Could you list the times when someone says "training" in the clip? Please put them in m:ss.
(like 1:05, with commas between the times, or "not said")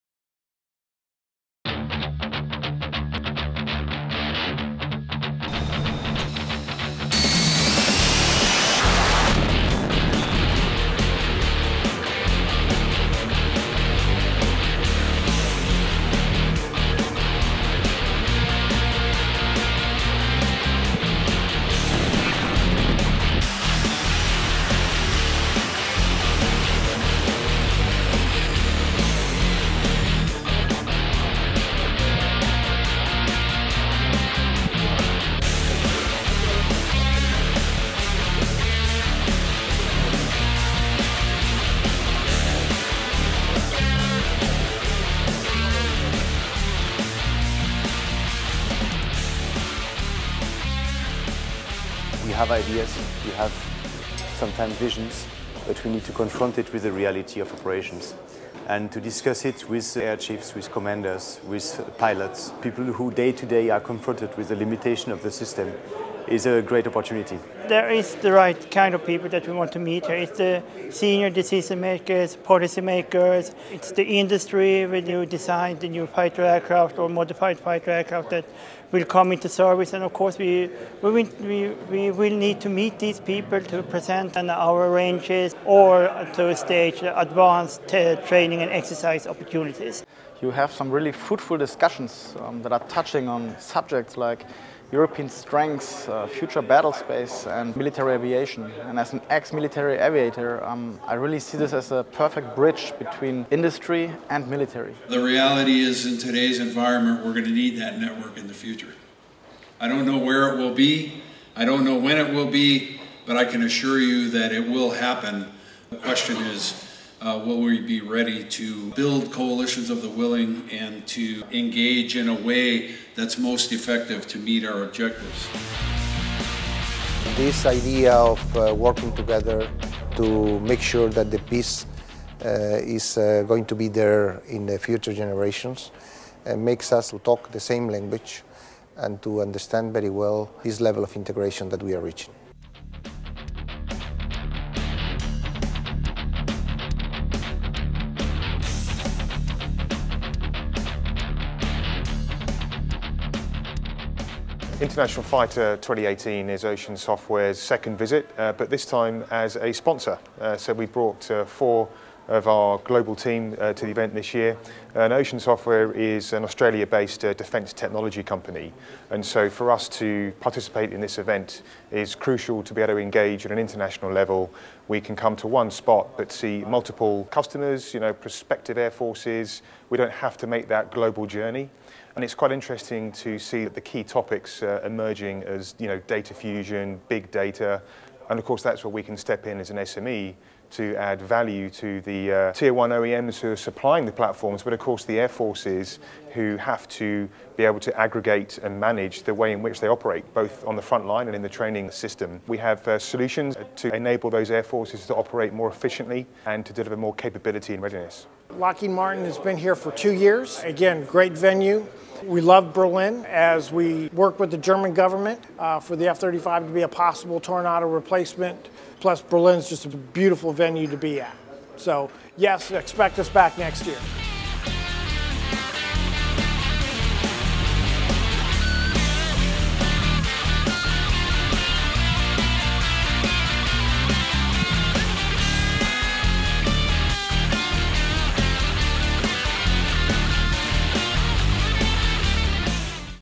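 1:28, 3:21.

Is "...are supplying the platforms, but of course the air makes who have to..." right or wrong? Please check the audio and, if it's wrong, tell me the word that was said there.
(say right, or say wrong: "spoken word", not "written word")
wrong: "forces", not "makes".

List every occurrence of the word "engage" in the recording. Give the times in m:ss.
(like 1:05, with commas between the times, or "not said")
2:01, 2:52.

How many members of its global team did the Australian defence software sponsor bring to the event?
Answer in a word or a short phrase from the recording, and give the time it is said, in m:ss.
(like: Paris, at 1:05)
4, at 2:41.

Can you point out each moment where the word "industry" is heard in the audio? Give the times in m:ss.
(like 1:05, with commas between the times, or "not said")
1:14, 1:43.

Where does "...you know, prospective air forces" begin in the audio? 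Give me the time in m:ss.
2:57.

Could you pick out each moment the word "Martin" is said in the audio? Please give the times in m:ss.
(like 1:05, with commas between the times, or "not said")
3:28.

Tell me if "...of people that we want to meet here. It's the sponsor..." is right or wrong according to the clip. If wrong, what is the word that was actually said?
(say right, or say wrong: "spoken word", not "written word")
wrong: "senior", not "sponsor".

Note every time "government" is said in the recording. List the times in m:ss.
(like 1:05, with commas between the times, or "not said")
3:34.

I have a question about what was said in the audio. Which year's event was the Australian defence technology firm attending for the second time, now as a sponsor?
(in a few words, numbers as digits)
International Fighter 2018.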